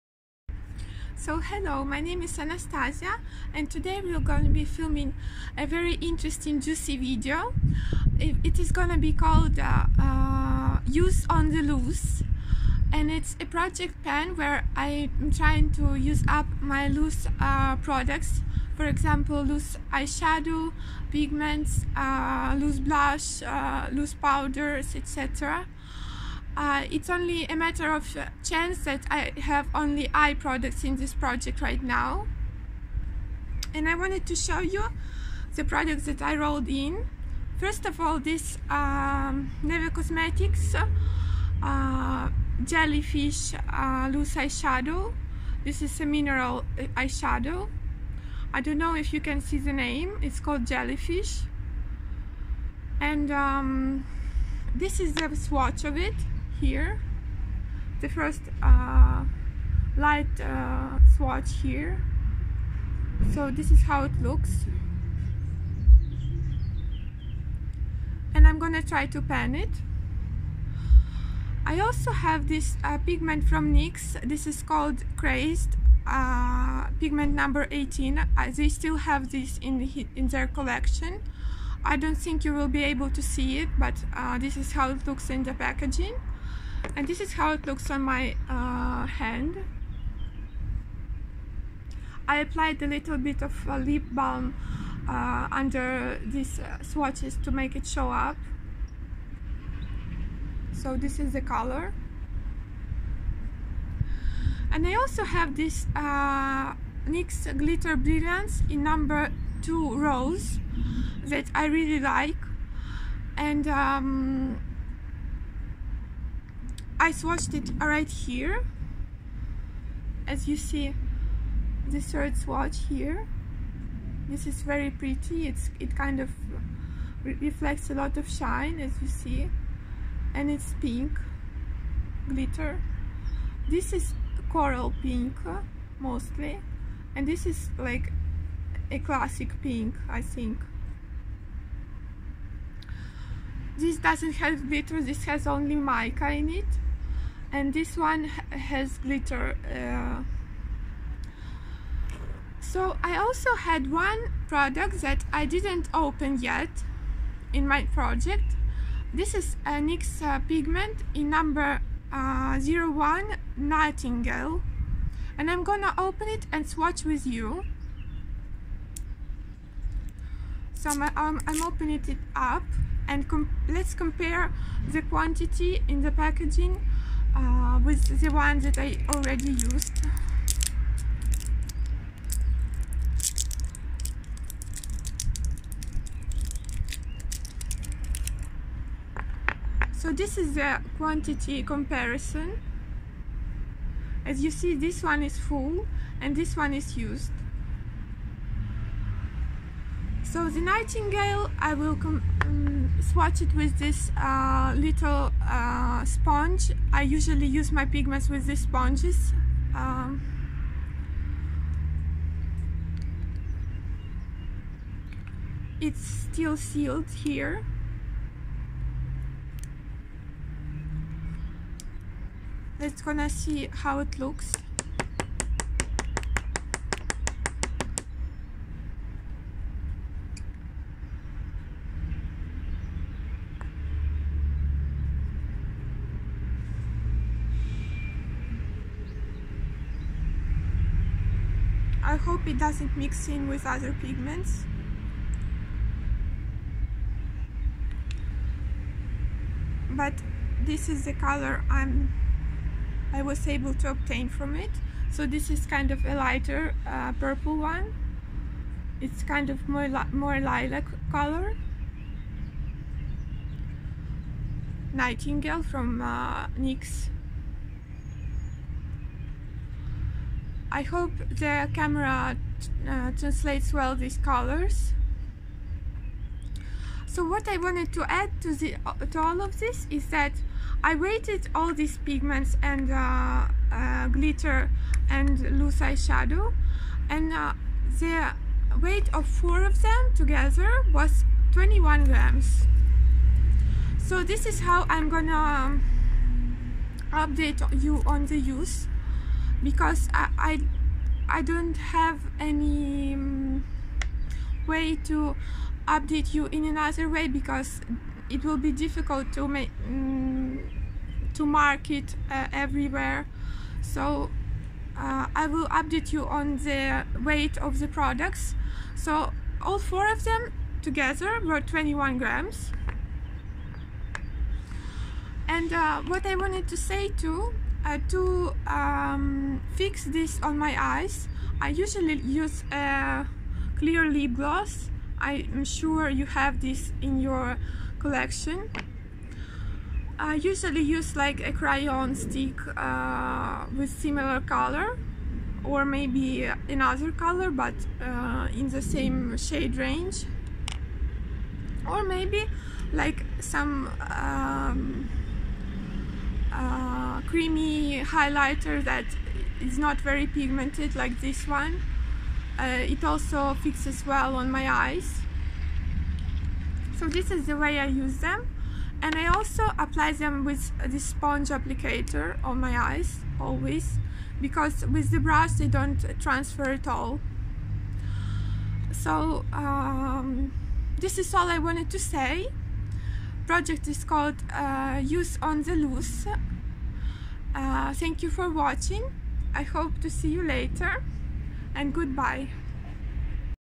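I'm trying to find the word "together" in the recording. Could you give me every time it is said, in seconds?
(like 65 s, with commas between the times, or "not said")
290 s, 320 s.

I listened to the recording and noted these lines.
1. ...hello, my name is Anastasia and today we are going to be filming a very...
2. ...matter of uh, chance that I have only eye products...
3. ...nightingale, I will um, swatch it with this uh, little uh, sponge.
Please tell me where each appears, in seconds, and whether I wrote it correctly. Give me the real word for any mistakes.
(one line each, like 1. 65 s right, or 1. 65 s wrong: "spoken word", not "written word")
1. 1 s right
2. 27 s right
3. 200 s right.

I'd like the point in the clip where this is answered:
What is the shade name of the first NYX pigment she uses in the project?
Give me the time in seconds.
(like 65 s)
75 s.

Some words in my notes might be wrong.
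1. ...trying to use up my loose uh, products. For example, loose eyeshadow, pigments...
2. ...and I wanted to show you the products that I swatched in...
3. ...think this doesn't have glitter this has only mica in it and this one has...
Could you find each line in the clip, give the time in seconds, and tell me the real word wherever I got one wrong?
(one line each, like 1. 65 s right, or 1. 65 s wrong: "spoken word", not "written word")
1. 15 s right
2. 33 s wrong: "rolled", not "swatched"
3. 140 s right.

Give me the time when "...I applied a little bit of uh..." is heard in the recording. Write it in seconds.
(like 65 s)
92 s.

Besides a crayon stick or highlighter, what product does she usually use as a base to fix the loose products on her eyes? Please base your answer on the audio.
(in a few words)
Clear lip gloss.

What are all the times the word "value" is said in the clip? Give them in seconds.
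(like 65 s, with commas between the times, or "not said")
not said.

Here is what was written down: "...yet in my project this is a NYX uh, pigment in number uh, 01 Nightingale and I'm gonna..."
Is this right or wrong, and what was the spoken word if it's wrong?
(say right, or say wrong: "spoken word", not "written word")
right.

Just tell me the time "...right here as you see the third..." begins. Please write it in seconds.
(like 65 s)
117 s.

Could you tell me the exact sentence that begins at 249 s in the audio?
But this is the color I'm, I was able to obtain from it.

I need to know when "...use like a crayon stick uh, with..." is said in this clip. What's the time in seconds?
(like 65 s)
340 s.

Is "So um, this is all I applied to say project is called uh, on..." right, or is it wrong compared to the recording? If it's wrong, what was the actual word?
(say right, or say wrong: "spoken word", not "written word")
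wrong: "wanted", not "applied".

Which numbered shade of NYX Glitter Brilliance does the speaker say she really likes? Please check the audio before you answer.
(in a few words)
2 Rose.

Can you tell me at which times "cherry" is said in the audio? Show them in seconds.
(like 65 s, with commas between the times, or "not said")
not said.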